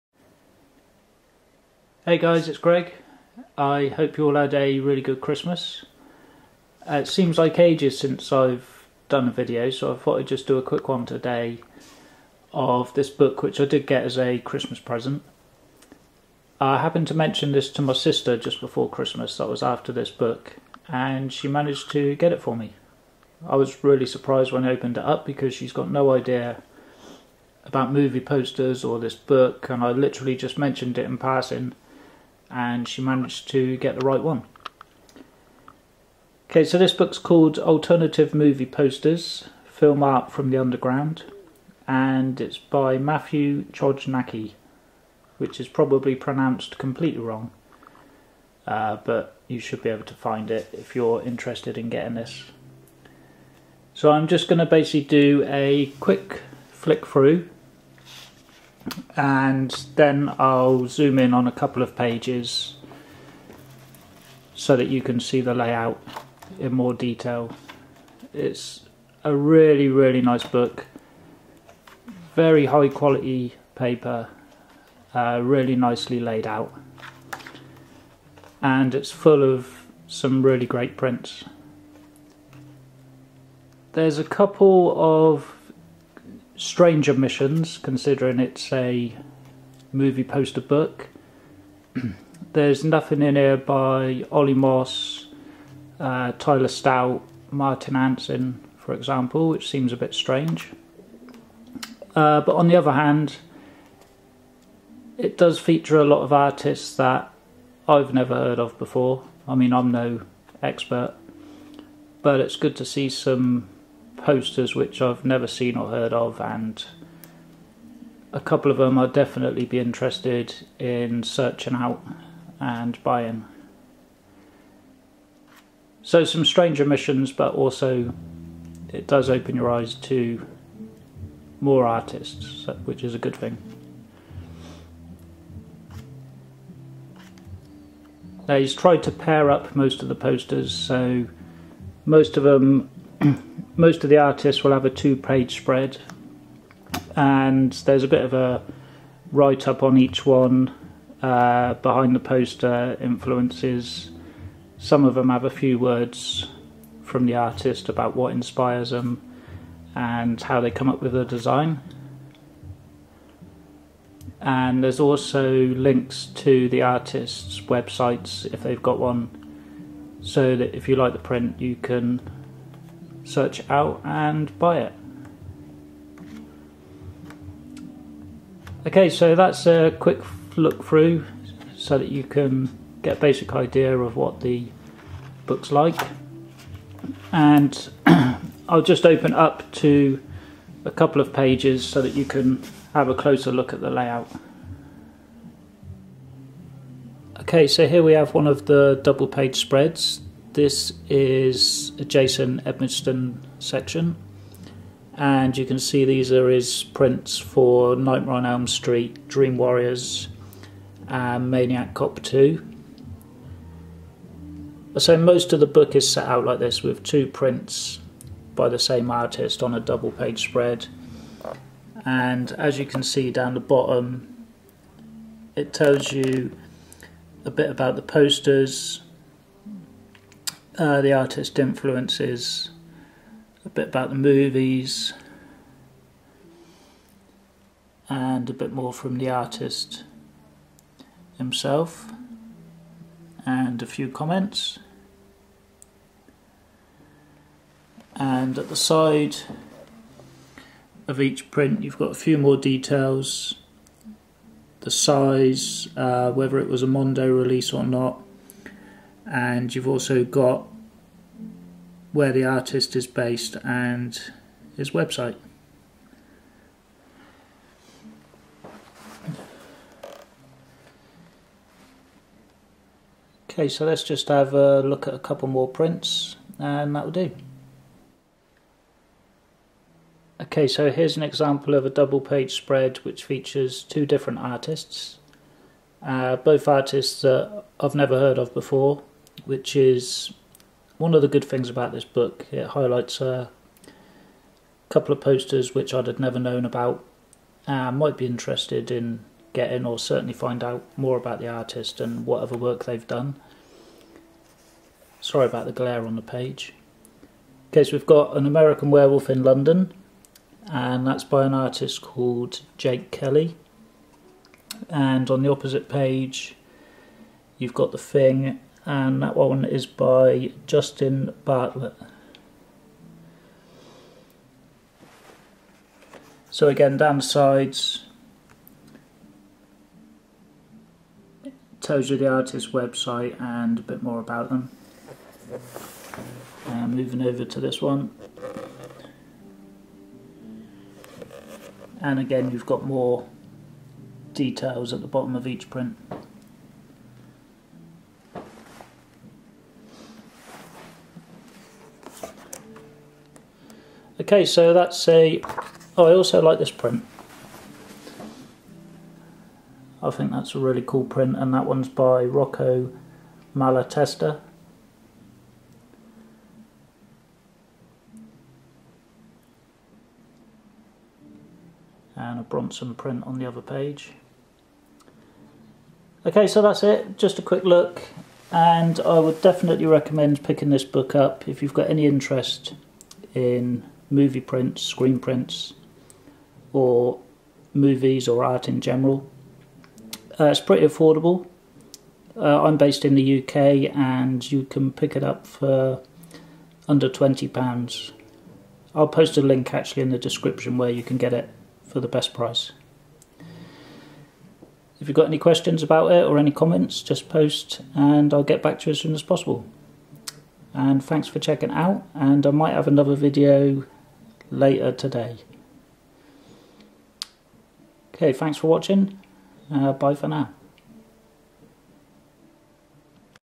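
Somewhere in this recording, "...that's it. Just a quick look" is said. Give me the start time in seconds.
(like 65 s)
376 s.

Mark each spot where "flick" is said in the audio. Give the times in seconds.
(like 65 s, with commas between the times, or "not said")
56 s.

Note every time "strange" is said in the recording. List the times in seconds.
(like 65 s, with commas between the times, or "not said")
86 s, 100 s, 126 s.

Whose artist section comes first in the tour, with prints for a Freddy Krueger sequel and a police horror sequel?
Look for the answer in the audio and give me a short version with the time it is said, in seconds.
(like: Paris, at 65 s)
Jason Edmiston, at 202 s.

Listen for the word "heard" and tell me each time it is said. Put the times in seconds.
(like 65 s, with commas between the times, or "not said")
108 s, 115 s, 288 s.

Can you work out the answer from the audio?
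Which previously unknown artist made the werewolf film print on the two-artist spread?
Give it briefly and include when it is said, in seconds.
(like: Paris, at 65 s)
Jake Kelly, at 312 s.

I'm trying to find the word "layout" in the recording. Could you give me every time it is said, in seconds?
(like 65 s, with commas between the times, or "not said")
65 s, 193 s.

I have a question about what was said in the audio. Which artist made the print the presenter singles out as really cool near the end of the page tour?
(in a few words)
Rocco Malatesta.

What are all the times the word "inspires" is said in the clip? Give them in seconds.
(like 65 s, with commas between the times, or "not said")
158 s.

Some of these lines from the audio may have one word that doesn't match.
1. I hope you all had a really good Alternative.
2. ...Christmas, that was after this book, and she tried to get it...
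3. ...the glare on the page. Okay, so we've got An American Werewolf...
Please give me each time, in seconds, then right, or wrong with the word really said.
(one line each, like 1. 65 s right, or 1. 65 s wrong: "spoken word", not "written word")
1. 3 s wrong: "Christmas", not "Alternative"
2. 18 s wrong: "managed", not "tried"
3. 305 s right.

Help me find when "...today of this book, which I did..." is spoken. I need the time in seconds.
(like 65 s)
11 s.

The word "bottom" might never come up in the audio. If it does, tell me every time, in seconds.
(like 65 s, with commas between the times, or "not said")
223 s, 345 s.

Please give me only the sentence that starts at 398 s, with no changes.
I'll post a link actually in the description where you can get it for the best price.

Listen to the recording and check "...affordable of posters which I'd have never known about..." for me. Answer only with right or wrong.
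wrong.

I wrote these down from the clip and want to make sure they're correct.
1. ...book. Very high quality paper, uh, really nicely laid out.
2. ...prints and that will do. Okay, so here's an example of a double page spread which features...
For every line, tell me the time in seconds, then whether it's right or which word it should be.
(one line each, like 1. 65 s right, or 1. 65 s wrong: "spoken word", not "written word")
1. 70 s right
2. 275 s right.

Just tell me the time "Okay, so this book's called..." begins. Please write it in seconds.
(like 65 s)
36 s.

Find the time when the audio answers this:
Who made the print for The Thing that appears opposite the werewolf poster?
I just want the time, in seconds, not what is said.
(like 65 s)
320 s.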